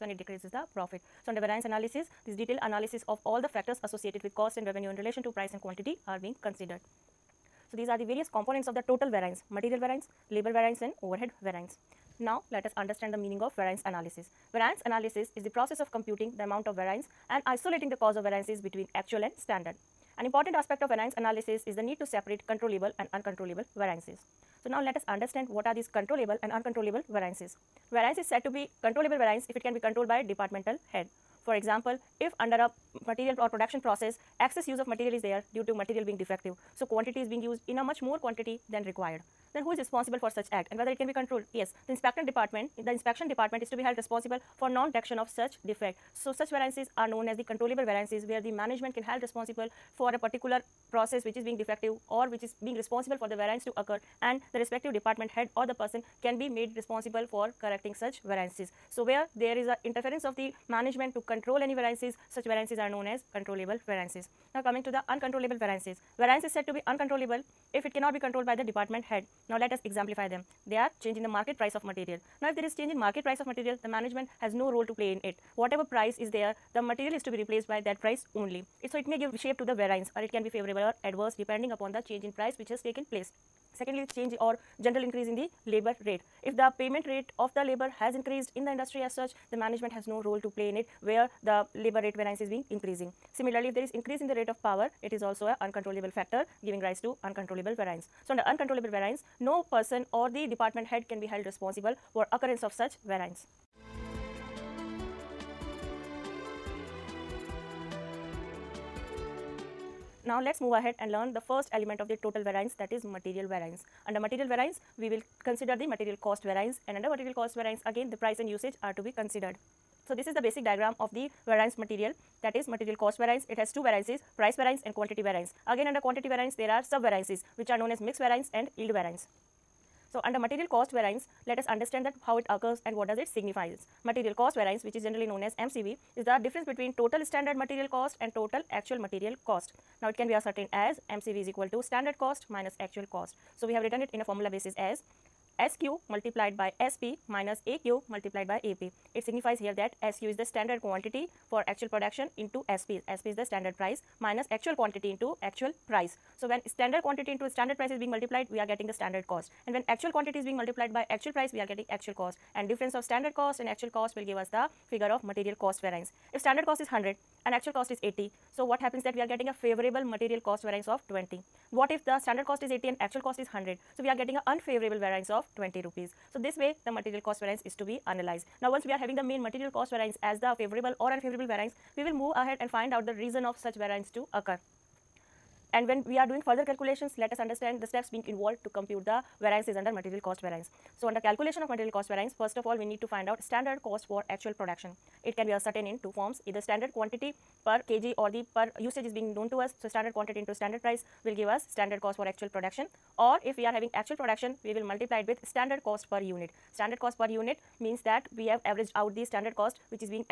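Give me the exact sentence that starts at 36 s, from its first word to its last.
So, quantity is being used in a much more quantity than required.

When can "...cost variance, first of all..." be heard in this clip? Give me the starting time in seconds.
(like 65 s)
191 s.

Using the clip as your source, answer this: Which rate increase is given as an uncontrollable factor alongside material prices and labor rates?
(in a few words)
Rate of power.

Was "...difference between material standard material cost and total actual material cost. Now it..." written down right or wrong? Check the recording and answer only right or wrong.
wrong.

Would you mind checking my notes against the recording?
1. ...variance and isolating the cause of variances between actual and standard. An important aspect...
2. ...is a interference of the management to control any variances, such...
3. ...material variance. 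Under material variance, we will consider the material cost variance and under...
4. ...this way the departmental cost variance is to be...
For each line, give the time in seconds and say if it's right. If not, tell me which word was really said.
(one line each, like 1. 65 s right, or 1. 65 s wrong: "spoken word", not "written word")
1. 16 s right
2. 59 s right
3. 113 s right
4. 176 s wrong: "material", not "departmental".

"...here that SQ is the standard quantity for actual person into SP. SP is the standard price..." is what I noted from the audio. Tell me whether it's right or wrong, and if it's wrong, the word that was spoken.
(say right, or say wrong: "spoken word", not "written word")
wrong: "production", not "person".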